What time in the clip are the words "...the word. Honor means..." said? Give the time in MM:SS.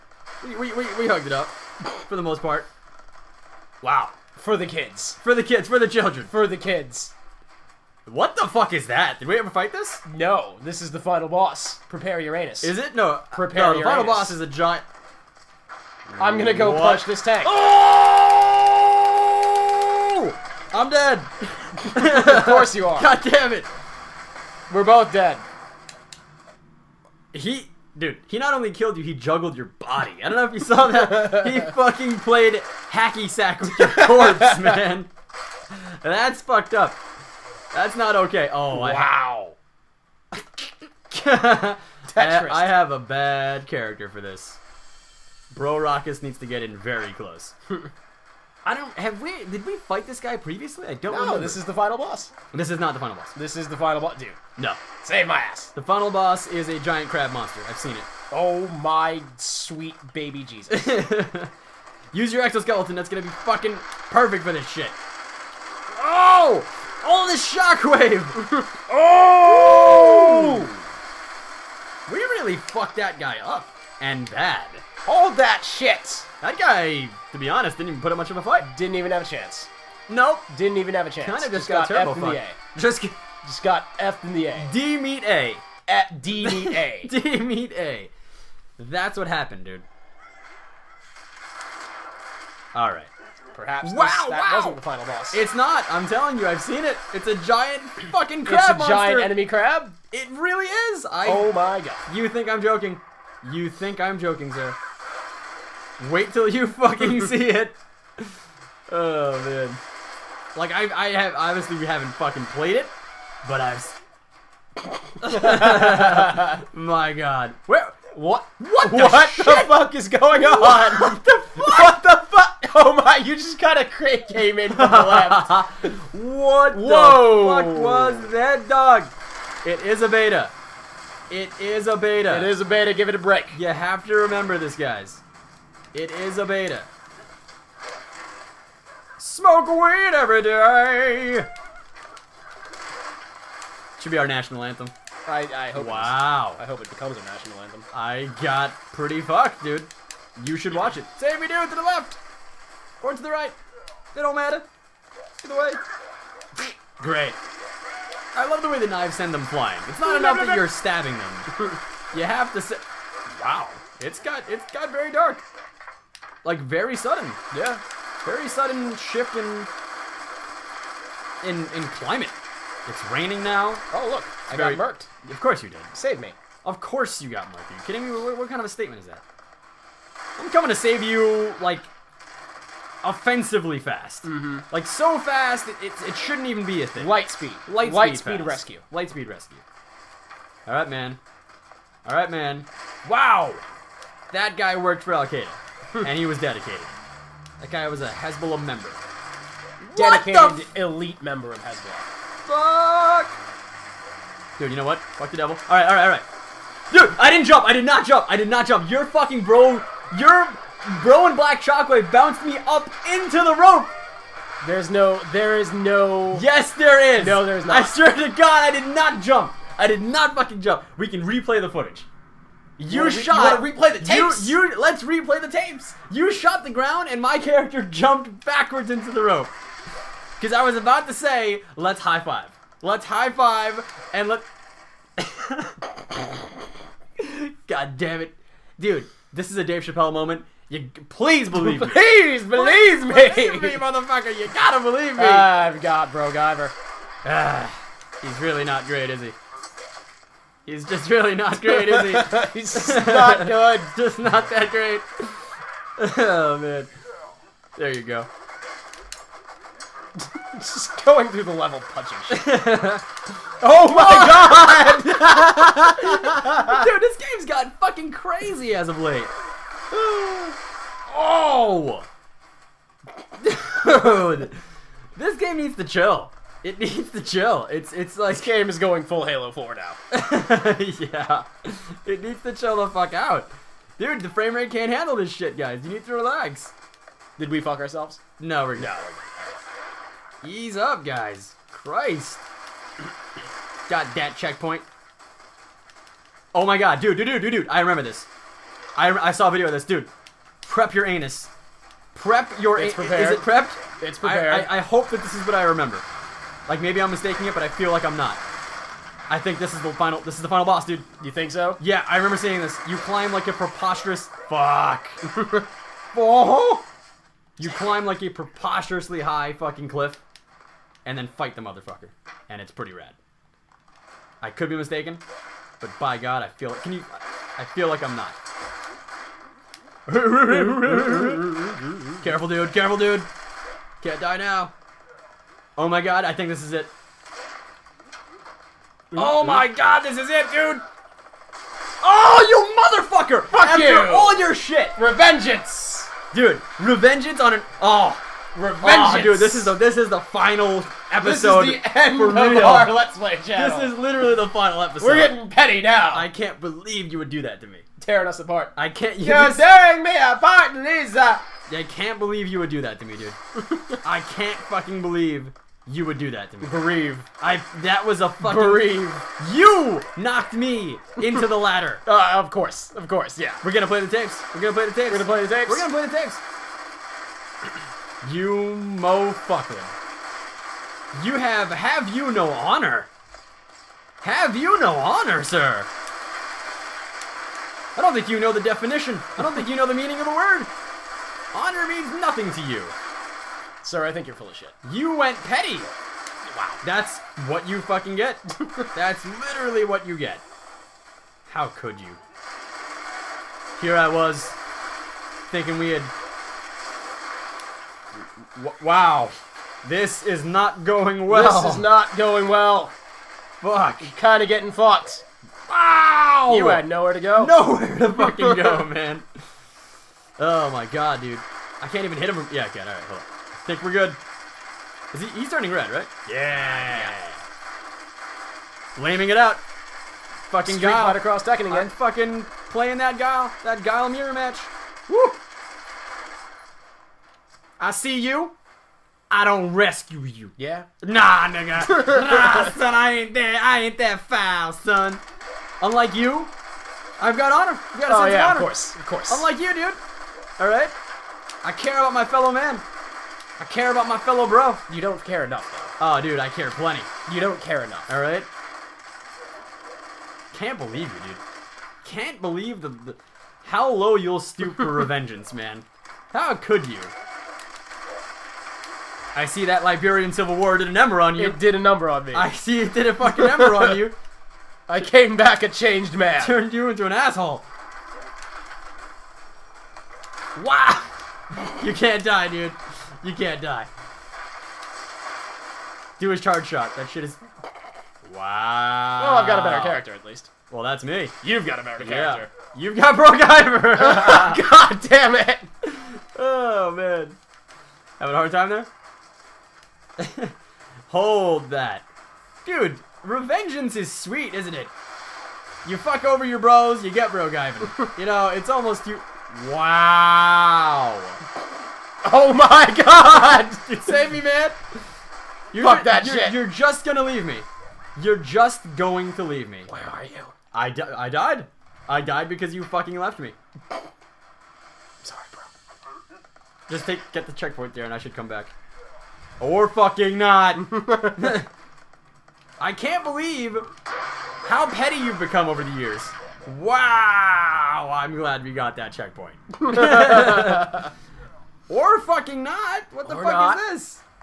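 06:30.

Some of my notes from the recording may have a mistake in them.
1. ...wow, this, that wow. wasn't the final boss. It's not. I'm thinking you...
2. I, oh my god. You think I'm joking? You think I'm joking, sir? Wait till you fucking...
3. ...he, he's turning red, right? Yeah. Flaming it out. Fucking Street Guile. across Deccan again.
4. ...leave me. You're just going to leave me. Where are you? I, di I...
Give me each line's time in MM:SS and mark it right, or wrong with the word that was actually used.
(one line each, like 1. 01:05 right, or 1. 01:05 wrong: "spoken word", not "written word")
1. 01:33 wrong: "telling", not "thinking"
2. 01:41 right
3. 07:05 right
4. 08:37 right.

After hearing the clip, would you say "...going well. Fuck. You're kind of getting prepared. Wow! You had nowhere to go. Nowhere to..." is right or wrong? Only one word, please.
wrong.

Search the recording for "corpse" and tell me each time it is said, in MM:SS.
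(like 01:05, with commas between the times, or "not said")
00:33.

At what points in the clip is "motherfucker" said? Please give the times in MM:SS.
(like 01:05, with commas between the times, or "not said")
04:03, 05:21, 05:43.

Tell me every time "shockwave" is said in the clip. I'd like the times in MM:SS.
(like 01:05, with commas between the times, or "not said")
01:07, 03:31.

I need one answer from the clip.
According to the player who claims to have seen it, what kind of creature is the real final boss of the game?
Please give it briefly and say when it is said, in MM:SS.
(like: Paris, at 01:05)
Giant crab monster, at 00:56.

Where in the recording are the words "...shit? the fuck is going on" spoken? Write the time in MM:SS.
01:59.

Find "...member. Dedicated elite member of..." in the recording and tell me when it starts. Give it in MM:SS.
03:18.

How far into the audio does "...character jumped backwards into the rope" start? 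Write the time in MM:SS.
03:47.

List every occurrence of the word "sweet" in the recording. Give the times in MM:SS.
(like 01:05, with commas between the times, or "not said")
00:59, 08:24.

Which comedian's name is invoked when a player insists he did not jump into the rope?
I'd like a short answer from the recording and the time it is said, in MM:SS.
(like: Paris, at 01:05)
Dave Chappelle, at 03:59.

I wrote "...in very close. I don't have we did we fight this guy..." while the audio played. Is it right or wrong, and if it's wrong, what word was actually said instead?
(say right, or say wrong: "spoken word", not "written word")
right.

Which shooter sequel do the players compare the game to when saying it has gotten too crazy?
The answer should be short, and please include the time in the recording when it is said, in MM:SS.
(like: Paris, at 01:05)
Halo 4, at 04:39.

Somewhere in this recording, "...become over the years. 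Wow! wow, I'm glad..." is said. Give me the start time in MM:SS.
08:55.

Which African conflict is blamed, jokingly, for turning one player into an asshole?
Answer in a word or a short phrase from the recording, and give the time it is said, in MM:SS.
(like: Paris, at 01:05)
Liberian Civil War, at 07:49.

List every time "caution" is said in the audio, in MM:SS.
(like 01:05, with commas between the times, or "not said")
not said.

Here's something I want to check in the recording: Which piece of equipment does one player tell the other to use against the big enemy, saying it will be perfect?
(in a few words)
Exoskeleton.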